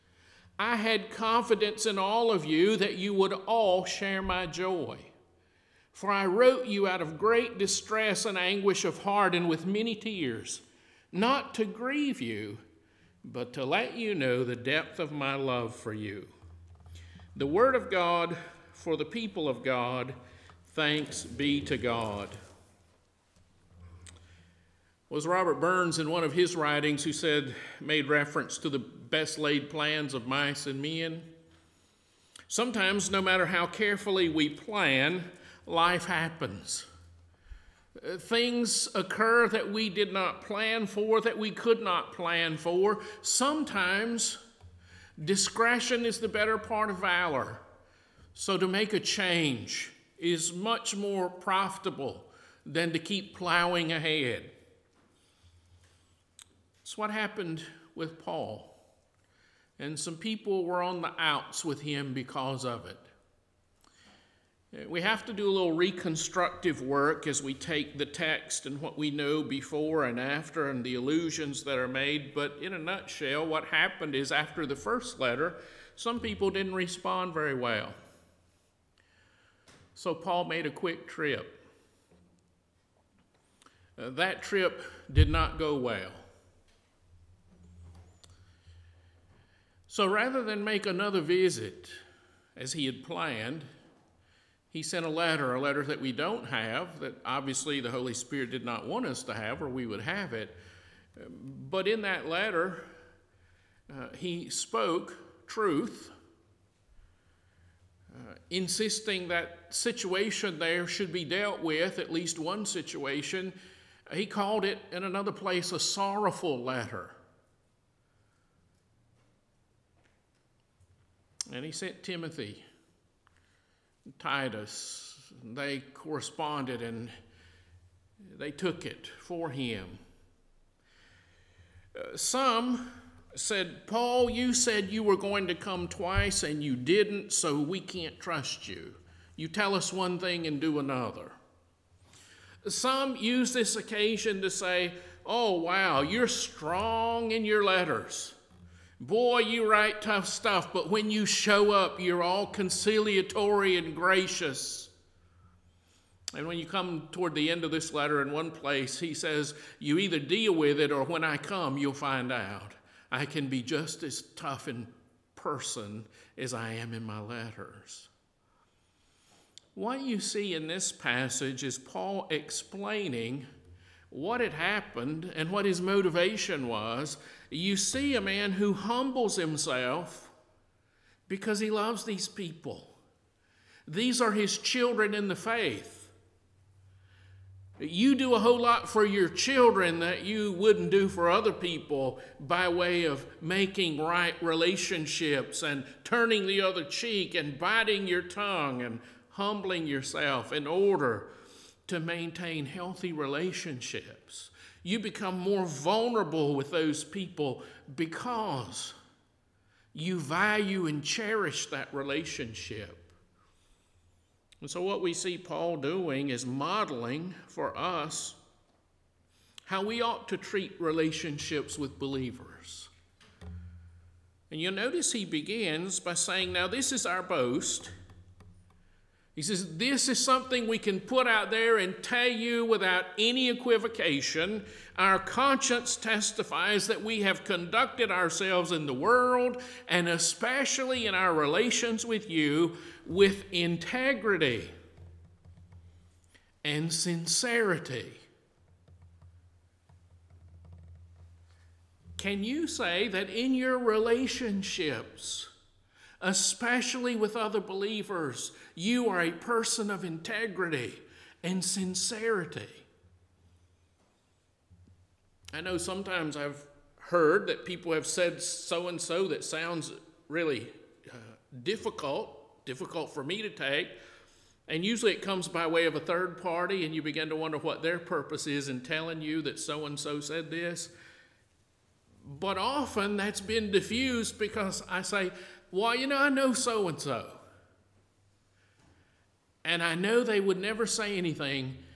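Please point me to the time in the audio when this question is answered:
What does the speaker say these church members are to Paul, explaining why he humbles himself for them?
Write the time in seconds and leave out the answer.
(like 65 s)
184 s.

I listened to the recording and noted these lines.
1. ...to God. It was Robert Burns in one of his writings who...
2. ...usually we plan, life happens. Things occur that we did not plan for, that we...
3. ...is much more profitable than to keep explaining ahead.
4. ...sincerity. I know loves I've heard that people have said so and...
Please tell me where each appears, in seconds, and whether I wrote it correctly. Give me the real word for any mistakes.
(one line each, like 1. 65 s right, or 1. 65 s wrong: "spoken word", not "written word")
1. 21 s right
2. 33 s wrong: "carefully", not "usually"
3. 50 s wrong: "plowing", not "explaining"
4. 261 s wrong: "sometimes", not "loves".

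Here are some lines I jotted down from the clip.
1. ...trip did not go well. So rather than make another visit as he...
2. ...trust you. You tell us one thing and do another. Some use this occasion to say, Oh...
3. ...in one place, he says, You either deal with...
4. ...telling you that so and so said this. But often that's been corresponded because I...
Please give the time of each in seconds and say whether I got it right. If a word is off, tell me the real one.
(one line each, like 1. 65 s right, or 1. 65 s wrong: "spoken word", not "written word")
1. 84 s right
2. 138 s right
3. 158 s right
4. 278 s wrong: "diffused", not "corresponded".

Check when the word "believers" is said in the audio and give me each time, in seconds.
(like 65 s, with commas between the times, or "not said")
221 s, 257 s.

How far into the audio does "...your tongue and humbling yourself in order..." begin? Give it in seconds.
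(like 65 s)
198 s.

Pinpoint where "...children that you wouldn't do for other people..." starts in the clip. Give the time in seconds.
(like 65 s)
189 s.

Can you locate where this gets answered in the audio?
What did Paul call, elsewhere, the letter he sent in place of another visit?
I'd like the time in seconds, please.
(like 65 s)
115 s.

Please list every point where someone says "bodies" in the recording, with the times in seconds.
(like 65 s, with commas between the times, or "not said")
not said.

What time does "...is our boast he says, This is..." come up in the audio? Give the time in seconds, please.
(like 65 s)
226 s.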